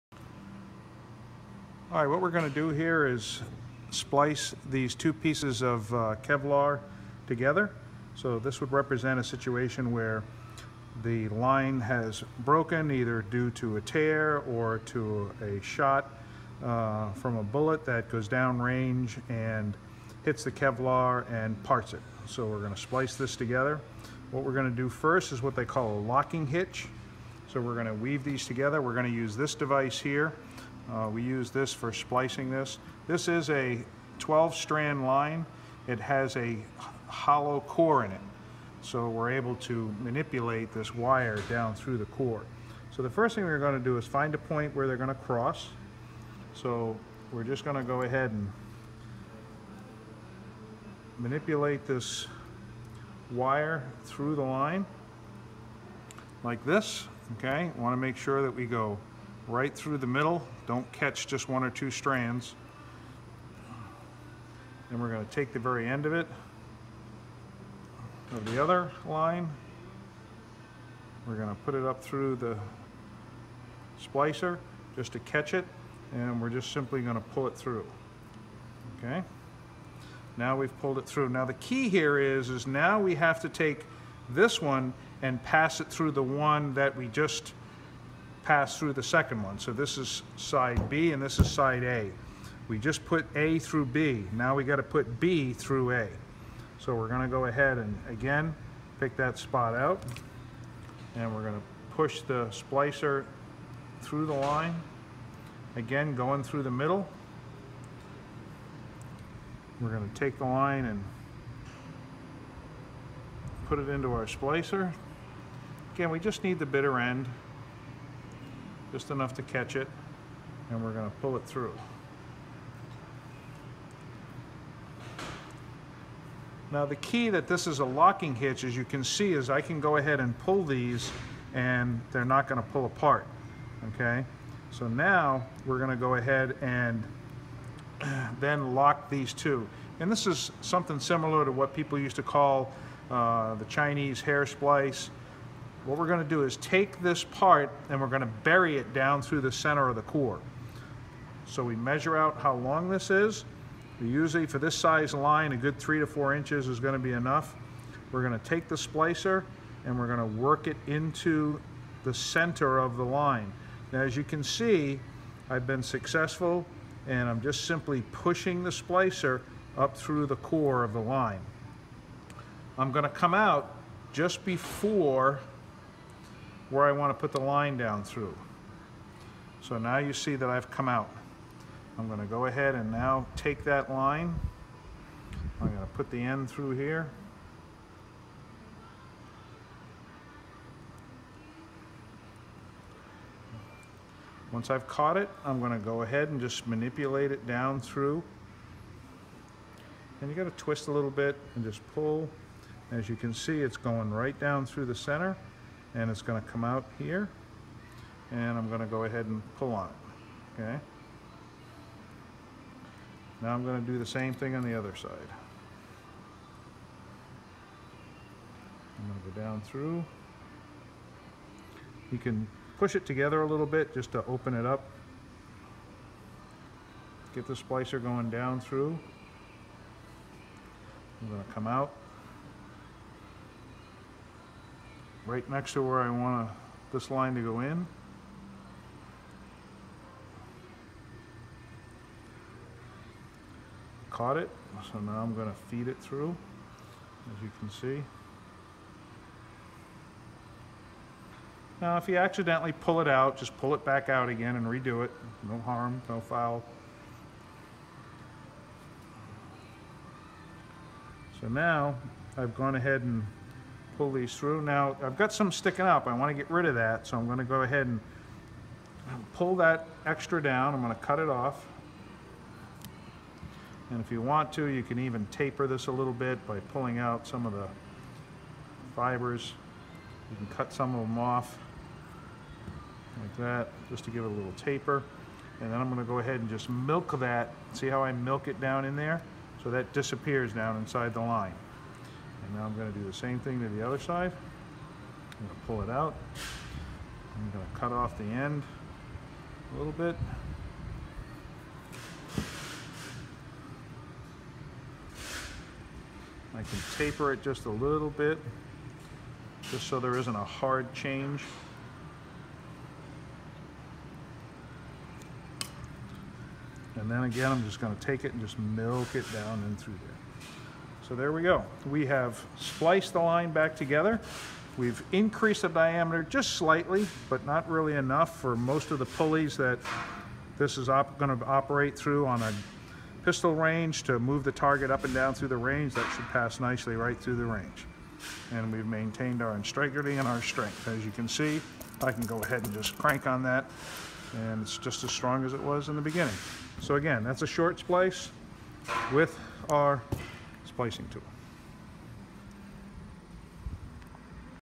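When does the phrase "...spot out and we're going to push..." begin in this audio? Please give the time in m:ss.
1:39.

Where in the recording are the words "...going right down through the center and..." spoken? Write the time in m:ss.
3:23.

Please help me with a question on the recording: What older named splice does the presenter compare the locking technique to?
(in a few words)
Chinese hair splice.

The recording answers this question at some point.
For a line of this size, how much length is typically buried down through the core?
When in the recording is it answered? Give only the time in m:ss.
2:35.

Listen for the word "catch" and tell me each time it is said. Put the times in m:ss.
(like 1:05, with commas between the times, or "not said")
1:00, 1:15, 1:59.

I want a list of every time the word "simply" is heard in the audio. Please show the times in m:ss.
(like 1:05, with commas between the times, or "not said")
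1:16, 2:47.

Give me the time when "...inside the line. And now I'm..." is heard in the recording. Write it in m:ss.
4:50.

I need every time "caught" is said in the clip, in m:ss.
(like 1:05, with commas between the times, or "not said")
3:14, 4:04.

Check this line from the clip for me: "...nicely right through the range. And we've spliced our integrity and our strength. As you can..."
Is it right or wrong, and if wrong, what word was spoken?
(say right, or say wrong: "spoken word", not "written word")
wrong: "maintained", not "spliced".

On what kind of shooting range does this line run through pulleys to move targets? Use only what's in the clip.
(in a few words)
pistol range.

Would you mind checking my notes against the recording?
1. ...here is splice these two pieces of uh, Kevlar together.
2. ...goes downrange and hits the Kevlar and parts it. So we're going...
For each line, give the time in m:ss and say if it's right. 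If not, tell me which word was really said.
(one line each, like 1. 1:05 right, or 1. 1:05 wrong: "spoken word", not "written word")
1. 0:02 right
2. 0:18 right.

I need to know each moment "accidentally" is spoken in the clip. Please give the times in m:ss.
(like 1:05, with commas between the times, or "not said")
4:12.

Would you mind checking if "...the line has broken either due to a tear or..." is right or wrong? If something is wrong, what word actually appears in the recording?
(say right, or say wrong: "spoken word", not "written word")
right.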